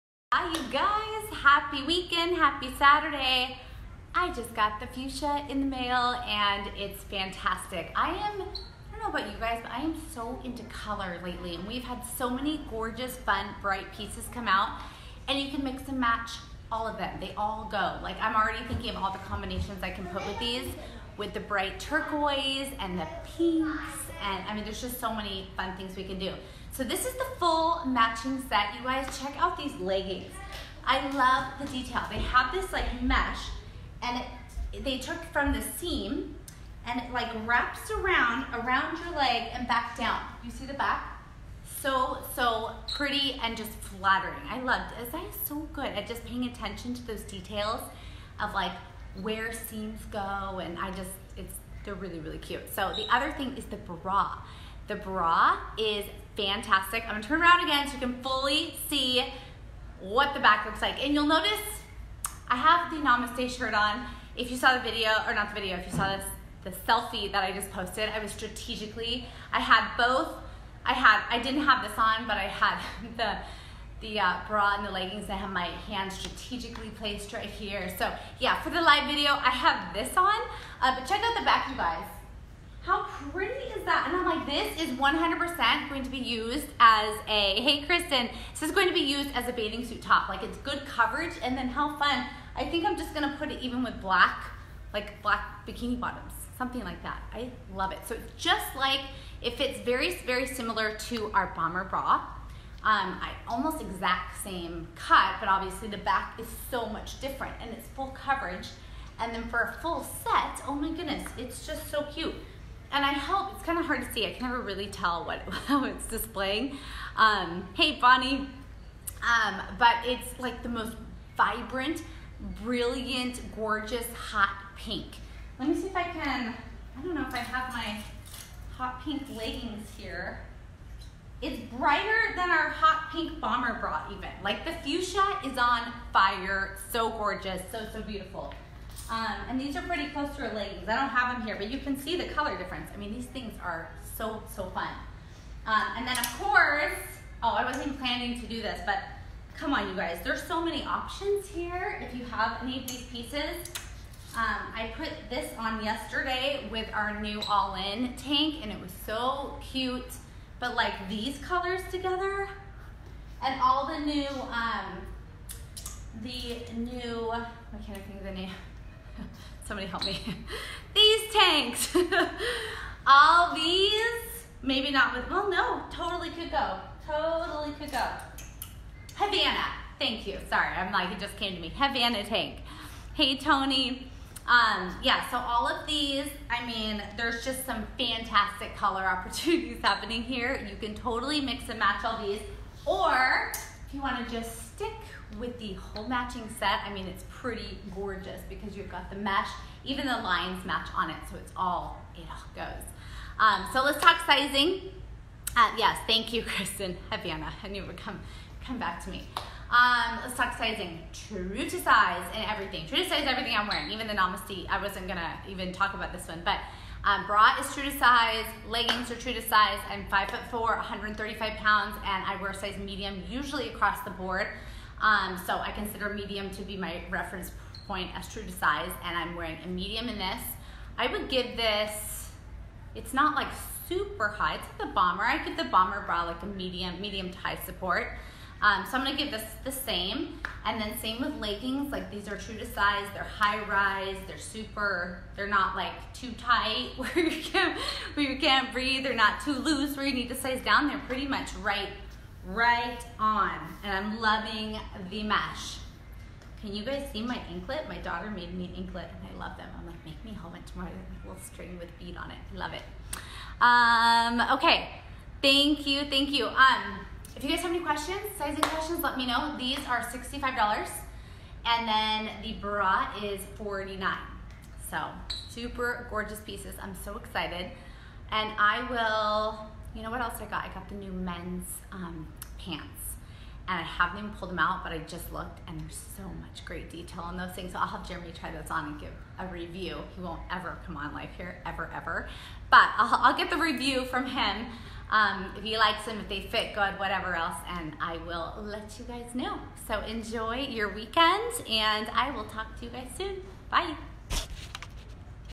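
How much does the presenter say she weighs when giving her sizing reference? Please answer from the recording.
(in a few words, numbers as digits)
135 pounds.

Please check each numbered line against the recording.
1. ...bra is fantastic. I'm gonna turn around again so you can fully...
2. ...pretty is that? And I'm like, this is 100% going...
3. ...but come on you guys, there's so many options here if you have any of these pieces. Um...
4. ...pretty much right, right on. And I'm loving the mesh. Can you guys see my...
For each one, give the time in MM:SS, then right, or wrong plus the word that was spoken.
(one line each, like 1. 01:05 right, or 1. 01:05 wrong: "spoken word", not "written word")
1. 00:54 right
2. 01:23 right
3. 02:28 right
4. 04:11 right.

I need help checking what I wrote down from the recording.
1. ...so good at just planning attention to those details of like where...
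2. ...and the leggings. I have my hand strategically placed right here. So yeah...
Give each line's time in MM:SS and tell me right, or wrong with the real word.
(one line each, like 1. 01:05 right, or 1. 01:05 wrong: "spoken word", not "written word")
1. 00:45 wrong: "paying", not "planning"
2. 01:14 right.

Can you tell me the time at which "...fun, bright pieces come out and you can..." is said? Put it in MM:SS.
00:13.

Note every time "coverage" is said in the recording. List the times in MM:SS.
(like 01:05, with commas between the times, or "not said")
01:30, 01:48.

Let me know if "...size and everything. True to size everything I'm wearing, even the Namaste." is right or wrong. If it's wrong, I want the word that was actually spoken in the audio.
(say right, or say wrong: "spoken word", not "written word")
right.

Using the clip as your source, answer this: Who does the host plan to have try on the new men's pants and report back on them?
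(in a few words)
Jeremy.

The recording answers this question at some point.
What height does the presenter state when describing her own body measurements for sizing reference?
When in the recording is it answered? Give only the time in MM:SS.
03:40.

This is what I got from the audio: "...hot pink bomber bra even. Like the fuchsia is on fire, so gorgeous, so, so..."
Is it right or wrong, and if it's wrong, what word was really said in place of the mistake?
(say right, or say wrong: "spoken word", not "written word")
right.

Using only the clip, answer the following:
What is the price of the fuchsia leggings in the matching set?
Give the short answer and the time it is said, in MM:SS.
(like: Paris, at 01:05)
$65, at 04:30.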